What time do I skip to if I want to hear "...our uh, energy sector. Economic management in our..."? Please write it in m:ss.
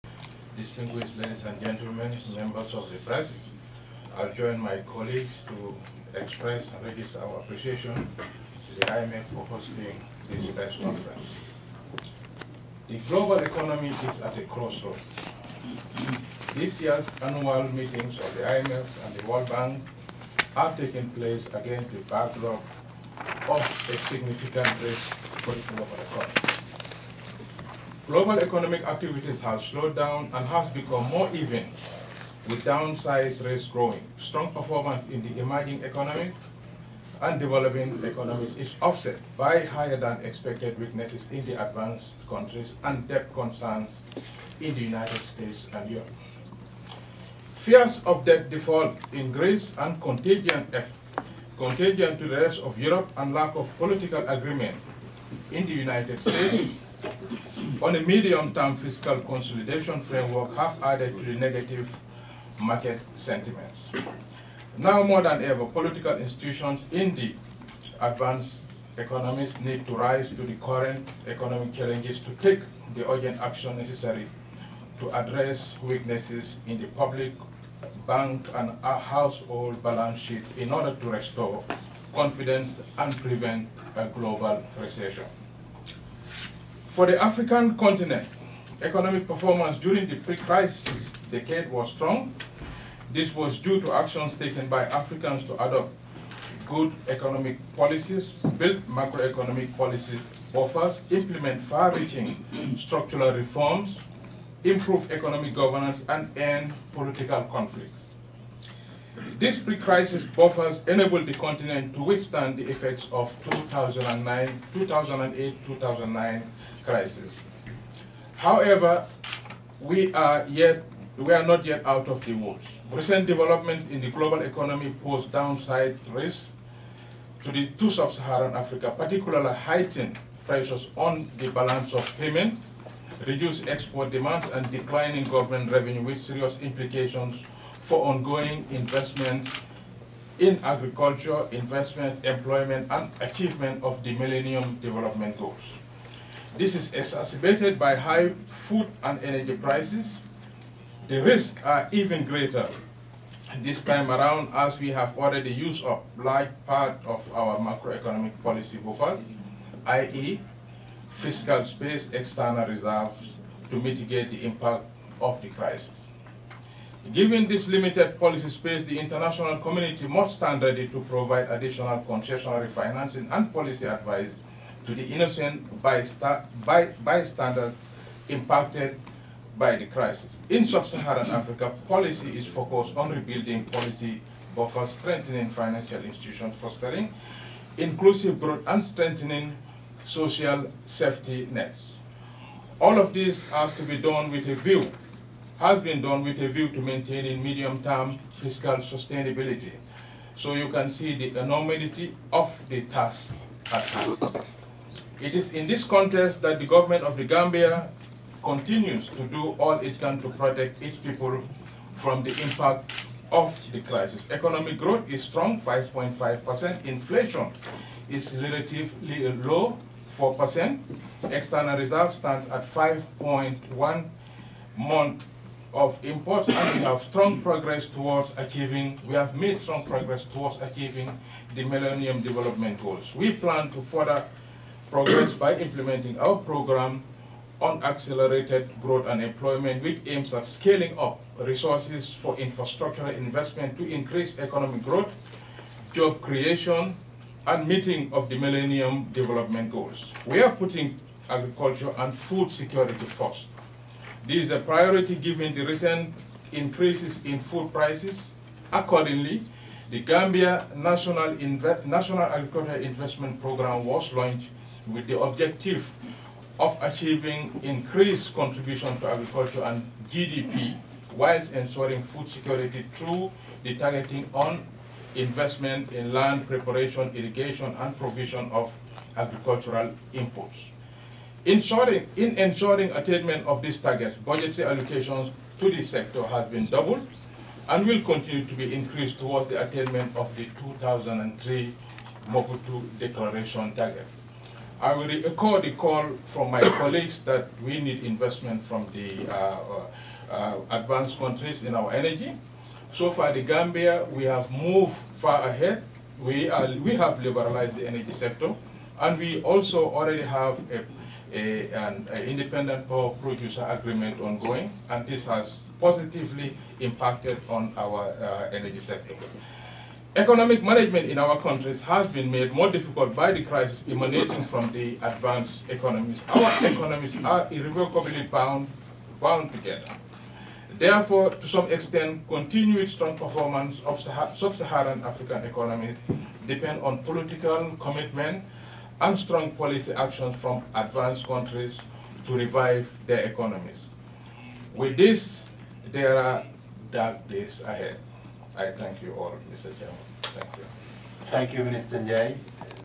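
5:17.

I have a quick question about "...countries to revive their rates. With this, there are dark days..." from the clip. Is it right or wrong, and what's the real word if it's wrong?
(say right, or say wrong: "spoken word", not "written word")
wrong: "economies", not "rates".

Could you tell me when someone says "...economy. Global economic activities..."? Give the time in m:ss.
0:26.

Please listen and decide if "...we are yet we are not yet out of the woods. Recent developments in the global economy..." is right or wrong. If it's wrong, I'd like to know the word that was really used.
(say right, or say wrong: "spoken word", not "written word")
right.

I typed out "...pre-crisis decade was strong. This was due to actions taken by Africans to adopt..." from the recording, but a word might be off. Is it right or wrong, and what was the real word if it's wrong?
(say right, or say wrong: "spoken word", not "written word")
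right.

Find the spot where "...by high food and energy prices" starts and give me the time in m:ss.
2:27.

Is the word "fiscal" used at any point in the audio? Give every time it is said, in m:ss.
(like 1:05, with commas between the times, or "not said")
0:58, 2:41, 3:18.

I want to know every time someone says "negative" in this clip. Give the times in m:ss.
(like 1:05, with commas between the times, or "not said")
1:01.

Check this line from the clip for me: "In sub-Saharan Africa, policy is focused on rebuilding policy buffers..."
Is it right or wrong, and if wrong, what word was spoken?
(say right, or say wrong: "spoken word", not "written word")
right.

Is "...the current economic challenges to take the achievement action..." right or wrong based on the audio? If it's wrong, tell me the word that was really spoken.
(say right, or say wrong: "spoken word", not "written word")
wrong: "urgent", not "achievement".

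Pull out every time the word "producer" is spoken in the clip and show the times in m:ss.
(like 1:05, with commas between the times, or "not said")
5:13.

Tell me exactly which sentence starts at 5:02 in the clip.
So far, the Gambia, we have moved far ahead.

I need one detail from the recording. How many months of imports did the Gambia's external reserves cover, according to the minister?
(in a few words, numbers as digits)
5.1.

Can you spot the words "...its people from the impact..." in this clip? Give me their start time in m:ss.
3:30.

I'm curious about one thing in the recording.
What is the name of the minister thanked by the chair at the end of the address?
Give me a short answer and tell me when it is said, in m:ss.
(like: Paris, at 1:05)
Minister Njie, at 5:51.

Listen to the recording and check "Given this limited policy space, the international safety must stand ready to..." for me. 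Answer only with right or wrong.
wrong.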